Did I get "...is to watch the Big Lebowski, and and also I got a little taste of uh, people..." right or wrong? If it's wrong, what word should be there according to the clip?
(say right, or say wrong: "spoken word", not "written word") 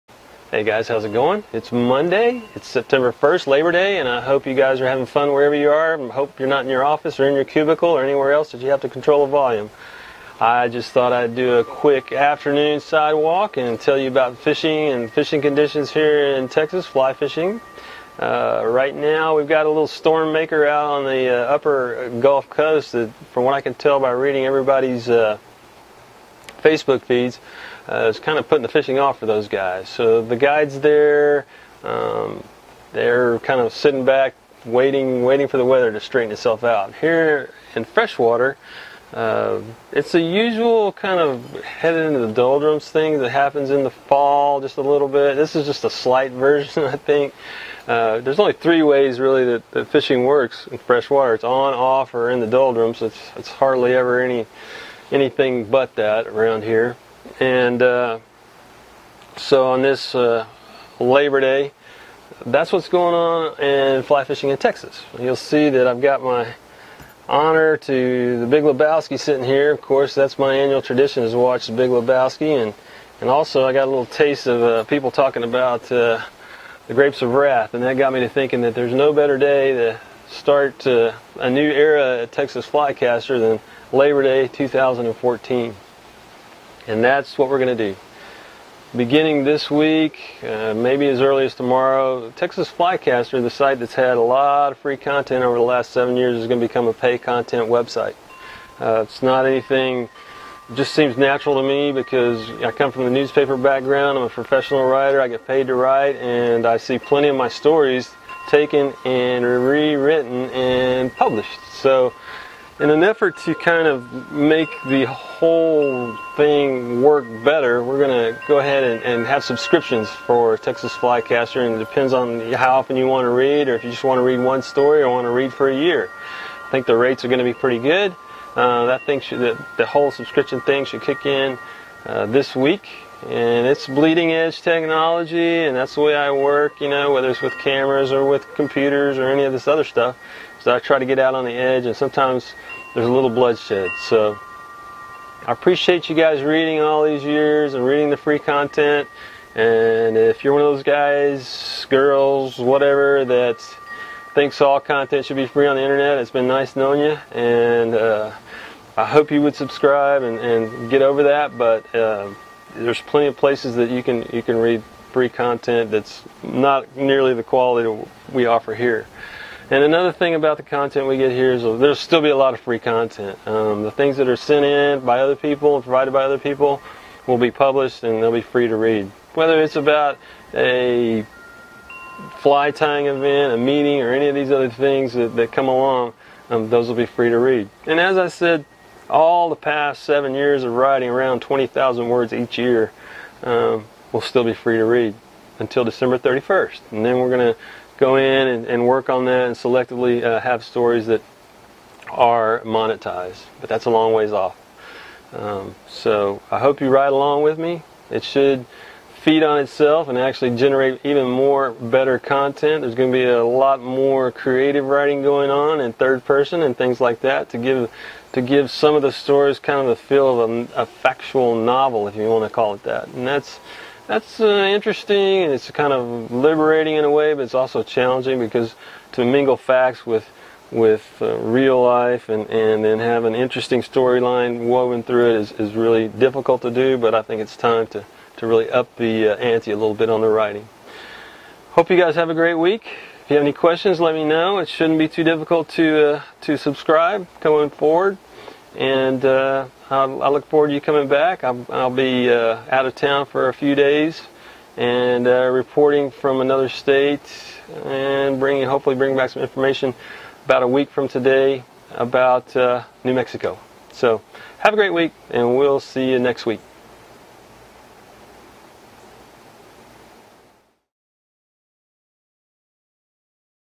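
right.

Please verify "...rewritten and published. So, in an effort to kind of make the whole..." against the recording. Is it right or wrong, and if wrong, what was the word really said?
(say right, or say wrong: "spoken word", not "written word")
right.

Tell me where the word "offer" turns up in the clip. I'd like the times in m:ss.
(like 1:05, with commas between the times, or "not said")
2:48.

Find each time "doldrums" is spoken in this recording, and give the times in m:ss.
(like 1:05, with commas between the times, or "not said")
0:42, 0:52.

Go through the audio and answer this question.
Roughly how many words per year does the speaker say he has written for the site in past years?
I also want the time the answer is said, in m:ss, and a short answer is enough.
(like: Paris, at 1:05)
20,000, at 3:11.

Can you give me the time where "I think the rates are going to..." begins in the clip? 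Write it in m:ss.
2:06.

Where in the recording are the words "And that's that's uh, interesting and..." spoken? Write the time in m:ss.
3:43.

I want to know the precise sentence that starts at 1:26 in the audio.
And that's what we're going to do.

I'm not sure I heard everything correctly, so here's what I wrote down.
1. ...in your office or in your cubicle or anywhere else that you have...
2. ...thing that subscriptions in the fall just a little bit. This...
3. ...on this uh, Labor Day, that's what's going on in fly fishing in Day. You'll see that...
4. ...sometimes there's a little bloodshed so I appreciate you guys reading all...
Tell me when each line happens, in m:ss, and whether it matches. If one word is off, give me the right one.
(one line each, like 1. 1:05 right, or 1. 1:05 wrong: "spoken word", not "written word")
1. 0:06 right
2. 0:42 wrong: "happens", not "subscriptions"
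3. 0:59 wrong: "Texas", not "Day"
4. 2:21 right.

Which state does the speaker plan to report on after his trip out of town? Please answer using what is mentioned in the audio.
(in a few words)
New Mexico.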